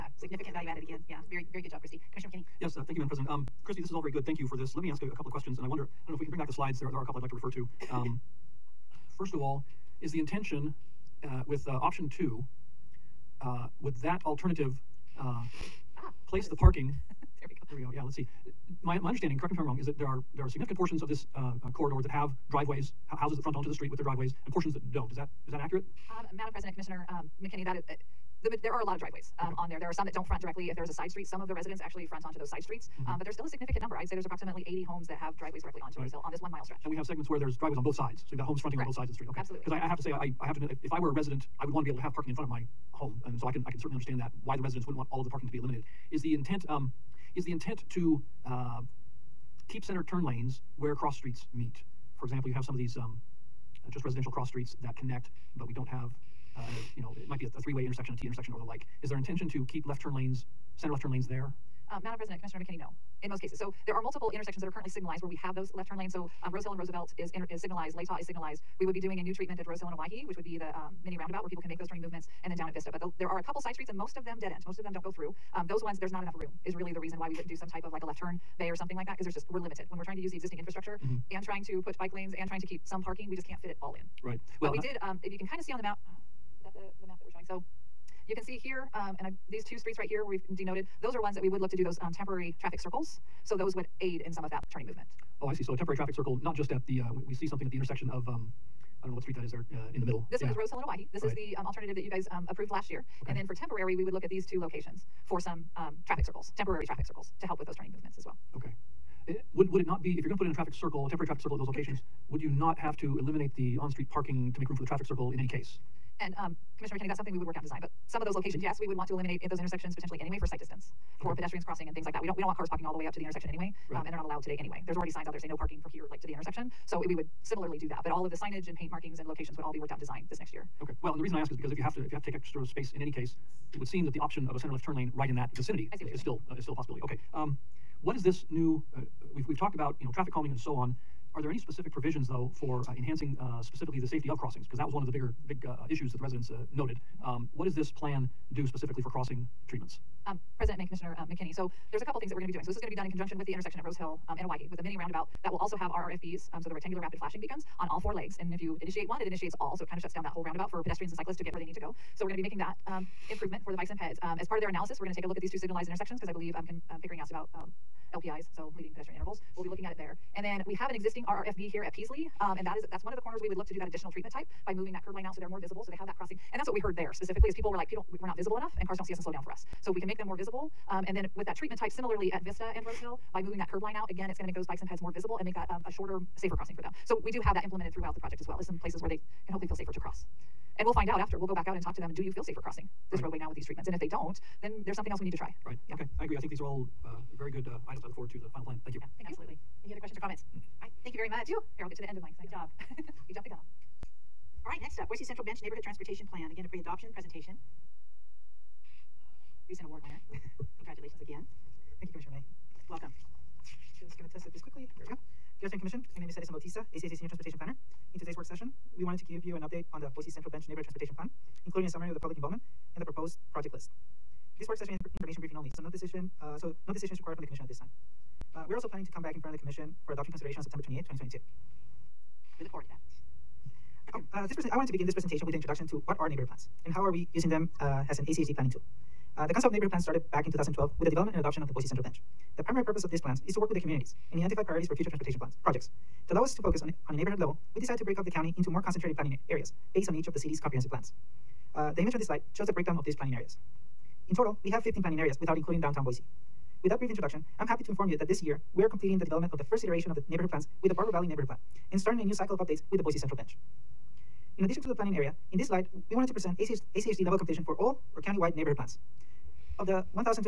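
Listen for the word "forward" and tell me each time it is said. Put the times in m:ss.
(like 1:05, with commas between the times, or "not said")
3:18, 3:52.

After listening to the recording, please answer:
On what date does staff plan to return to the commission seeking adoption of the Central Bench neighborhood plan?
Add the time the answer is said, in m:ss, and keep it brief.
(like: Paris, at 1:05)
September 28, 2022, at 3:50.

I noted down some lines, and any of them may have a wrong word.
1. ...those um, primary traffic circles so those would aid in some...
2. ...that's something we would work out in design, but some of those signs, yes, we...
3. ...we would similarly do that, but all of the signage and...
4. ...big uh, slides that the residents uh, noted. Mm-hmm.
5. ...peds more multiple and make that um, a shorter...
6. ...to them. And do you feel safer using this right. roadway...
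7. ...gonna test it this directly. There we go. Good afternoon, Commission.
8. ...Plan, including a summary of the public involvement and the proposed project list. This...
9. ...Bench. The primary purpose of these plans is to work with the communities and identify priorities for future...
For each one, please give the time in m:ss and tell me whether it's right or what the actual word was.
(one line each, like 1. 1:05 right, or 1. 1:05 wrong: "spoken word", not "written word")
1. 1:31 wrong: "temporary", not "primary"
2. 1:57 wrong: "locations", not "signs"
3. 2:07 right
4. 2:25 wrong: "issues", not "slides"
5. 3:04 wrong: "visible", not "multiple"
6. 3:11 wrong: "crossing", not "using"
7. 3:34 wrong: "quickly", not "directly"
8. 3:41 right
9. 4:02 right.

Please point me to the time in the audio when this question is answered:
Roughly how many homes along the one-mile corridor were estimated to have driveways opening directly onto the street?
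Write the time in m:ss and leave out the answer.
0:34.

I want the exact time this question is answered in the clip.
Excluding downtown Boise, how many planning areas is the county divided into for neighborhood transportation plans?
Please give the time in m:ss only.
4:14.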